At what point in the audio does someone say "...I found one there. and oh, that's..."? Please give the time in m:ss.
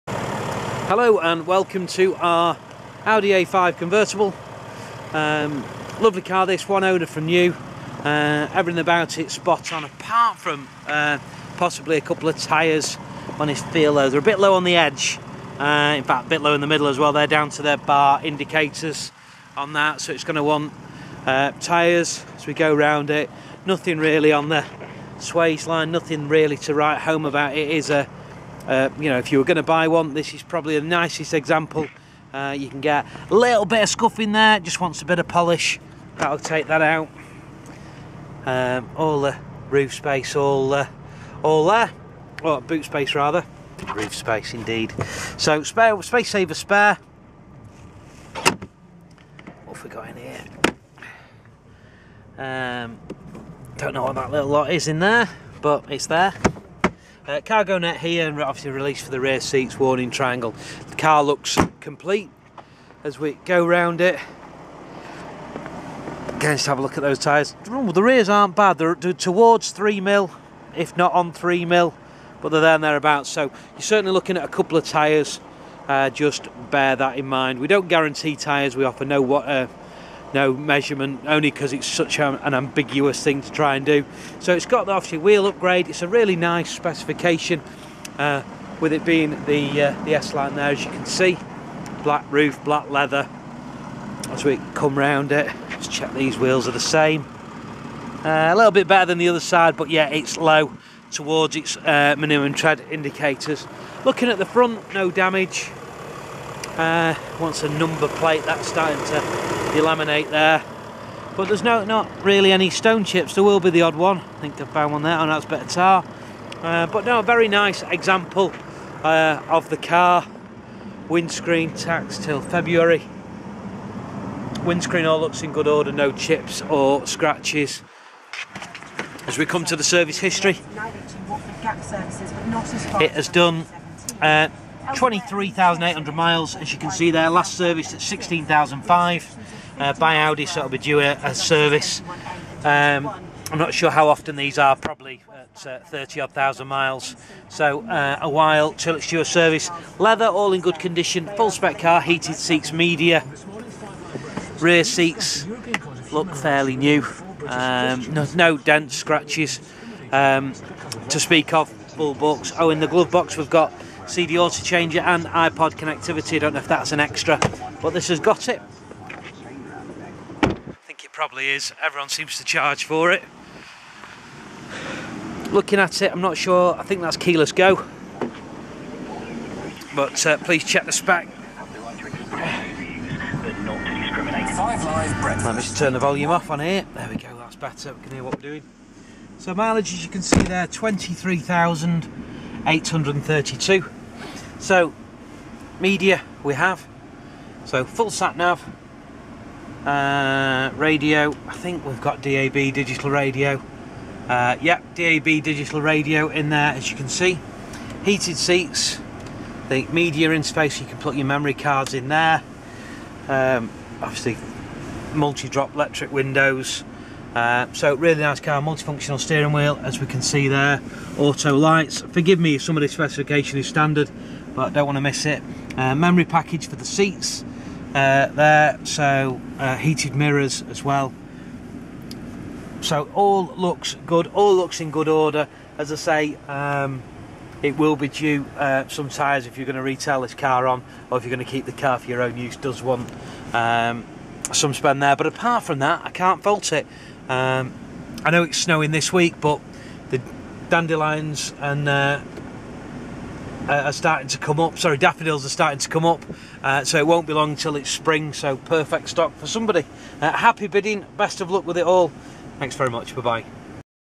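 1:54.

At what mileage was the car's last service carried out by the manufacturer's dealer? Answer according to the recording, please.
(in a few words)
16,005.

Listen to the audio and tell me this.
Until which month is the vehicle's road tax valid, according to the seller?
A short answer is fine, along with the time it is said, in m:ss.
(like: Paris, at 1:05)
February, at 2:02.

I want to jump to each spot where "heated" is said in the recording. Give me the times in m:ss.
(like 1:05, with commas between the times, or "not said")
2:32, 3:28, 3:49.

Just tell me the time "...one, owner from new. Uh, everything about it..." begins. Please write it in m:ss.
0:06.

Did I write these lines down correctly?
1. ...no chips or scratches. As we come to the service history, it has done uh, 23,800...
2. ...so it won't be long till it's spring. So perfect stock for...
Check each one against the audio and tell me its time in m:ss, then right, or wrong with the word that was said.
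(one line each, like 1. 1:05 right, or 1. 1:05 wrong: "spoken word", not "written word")
1. 2:05 right
2. 4:16 right.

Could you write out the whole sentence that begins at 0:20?
So it's going to want uh, tyres as we go round it.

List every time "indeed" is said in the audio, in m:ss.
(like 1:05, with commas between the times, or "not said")
0:44.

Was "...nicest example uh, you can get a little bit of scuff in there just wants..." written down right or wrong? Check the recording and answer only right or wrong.
right.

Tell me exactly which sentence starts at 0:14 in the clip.
They're a bit low on the edge.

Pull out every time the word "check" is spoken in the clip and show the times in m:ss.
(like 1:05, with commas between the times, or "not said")
1:35, 3:00.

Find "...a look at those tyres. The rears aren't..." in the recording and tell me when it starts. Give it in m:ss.
1:06.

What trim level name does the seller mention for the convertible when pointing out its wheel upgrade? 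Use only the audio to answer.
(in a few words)
S-line.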